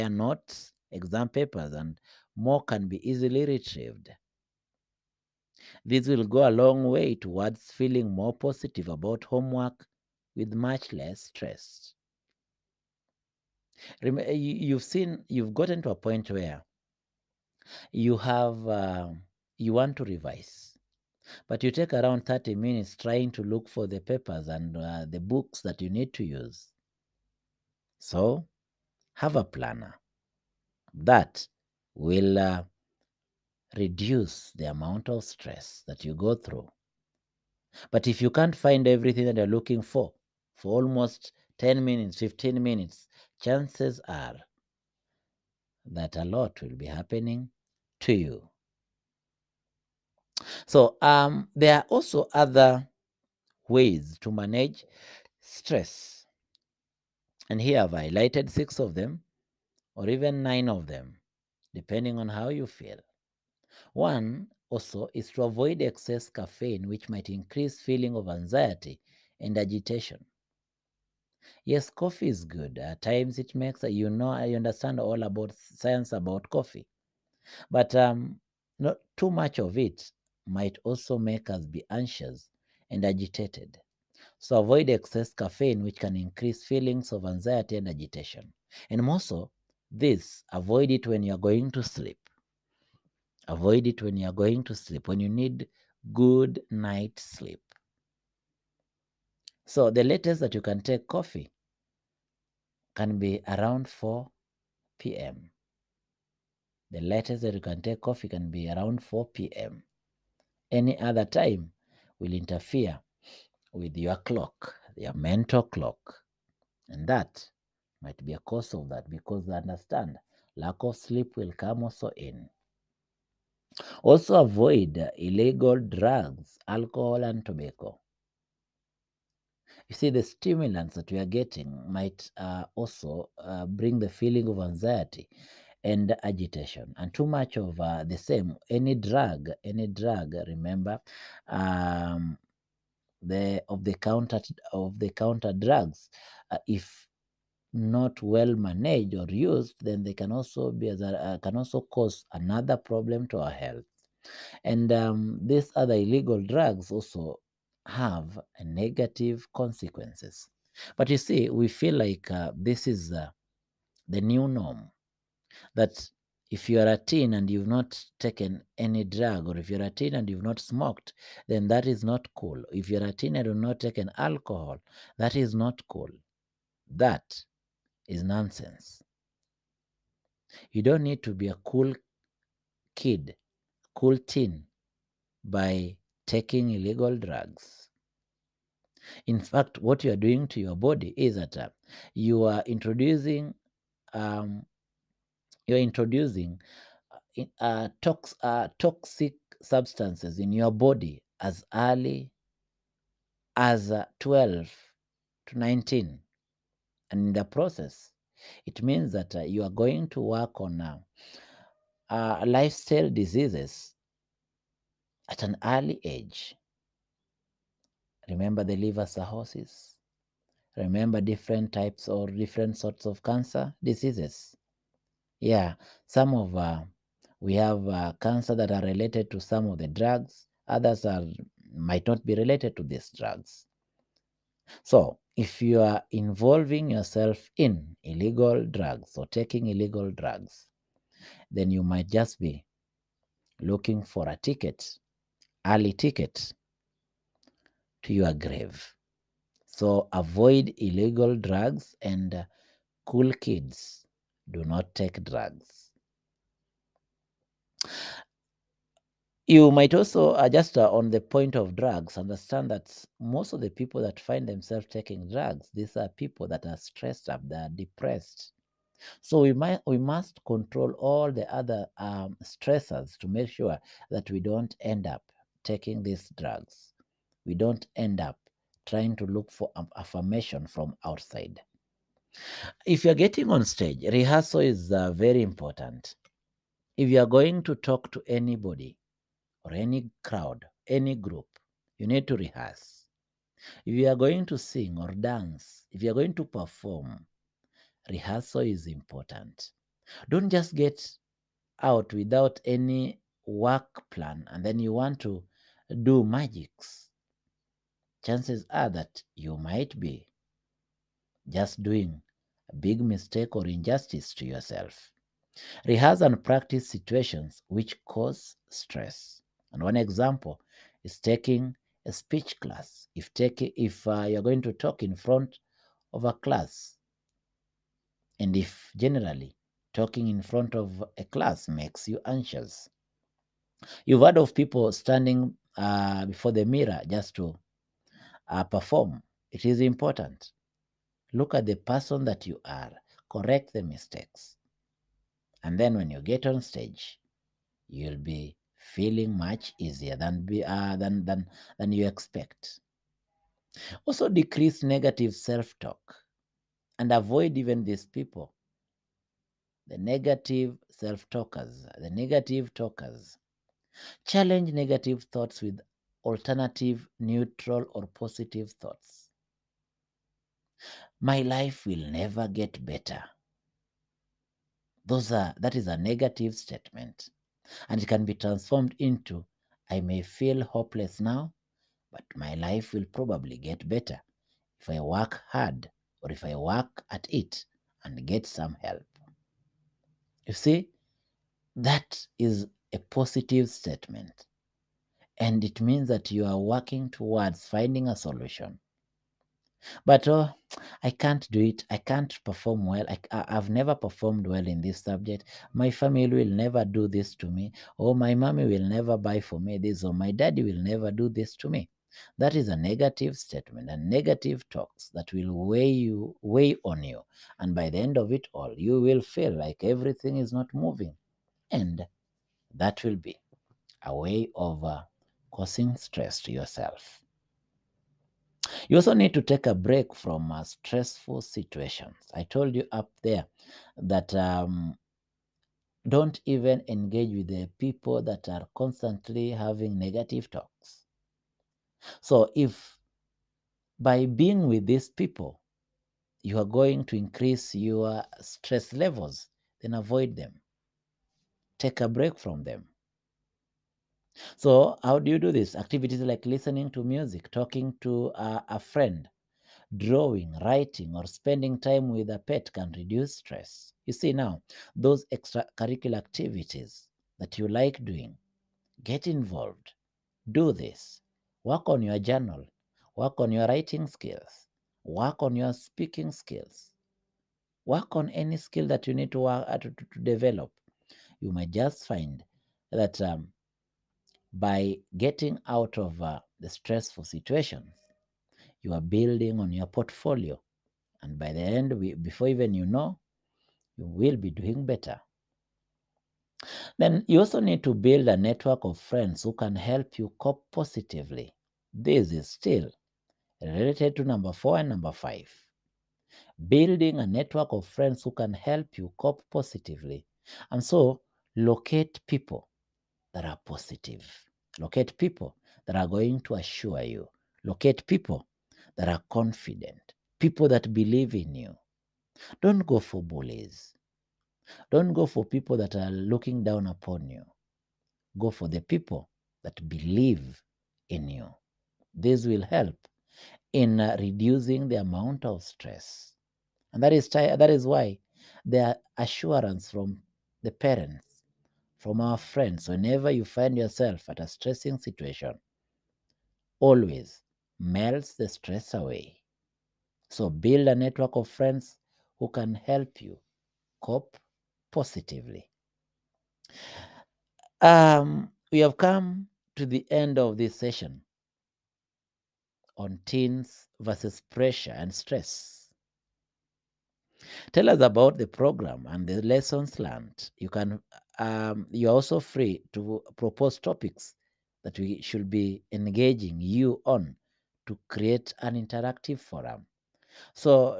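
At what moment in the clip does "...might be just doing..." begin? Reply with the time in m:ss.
5:09.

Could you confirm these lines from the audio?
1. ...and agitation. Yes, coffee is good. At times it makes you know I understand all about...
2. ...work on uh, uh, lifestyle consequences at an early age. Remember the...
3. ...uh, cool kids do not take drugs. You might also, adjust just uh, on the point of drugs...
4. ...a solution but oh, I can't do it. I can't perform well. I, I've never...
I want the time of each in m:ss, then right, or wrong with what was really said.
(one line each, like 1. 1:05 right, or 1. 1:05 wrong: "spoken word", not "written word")
1. 1:09 right
2. 3:30 wrong: "diseases", not "consequences"
3. 4:12 right
4. 6:38 right.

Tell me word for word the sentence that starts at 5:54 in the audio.
Also, decrease negative self talk and avoid even these people the negative self talkers, the negative talkers.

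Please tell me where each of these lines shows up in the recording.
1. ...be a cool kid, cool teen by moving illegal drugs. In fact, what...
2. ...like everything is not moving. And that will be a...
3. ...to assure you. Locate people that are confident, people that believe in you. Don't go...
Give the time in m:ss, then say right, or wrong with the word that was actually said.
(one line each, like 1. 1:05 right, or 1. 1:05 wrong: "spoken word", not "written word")
1. 3:01 wrong: "taking", not "moving"
2. 6:59 right
3. 8:36 right.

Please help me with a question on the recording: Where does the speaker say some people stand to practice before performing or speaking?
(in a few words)
Before the mirror.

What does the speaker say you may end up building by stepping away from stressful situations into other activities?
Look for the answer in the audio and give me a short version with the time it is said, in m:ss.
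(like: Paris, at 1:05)
Your portfolio, at 8:09.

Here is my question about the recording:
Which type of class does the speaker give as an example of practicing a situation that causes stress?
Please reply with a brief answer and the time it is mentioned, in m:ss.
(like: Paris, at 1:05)
A speech class, at 5:22.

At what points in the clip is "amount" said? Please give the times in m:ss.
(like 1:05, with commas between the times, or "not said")
0:34, 8:54.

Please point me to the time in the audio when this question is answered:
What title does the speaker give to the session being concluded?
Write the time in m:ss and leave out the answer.
9:23.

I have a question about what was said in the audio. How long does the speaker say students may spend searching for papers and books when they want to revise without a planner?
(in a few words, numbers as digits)
30 minutes.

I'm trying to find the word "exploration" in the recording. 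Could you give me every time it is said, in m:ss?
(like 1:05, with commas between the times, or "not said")
not said.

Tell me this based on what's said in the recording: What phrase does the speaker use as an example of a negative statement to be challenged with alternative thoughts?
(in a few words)
My life will never get better.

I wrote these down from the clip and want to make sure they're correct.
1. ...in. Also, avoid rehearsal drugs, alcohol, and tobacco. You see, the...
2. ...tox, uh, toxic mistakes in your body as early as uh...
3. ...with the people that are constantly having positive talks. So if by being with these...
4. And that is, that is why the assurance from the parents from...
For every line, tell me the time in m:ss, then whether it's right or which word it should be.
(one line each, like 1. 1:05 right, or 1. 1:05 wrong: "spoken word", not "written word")
1. 2:02 wrong: "illegal", not "rehearsal"
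2. 3:18 wrong: "substances", not "mistakes"
3. 7:17 wrong: "negative", not "positive"
4. 8:56 right.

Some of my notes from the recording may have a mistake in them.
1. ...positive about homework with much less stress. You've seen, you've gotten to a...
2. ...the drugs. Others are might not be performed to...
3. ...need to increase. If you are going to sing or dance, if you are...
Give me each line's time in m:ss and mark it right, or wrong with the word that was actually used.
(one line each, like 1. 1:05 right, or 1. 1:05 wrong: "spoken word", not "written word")
1. 0:08 right
2. 3:49 wrong: "related", not "performed"
3. 4:52 wrong: "rehearse", not "increase".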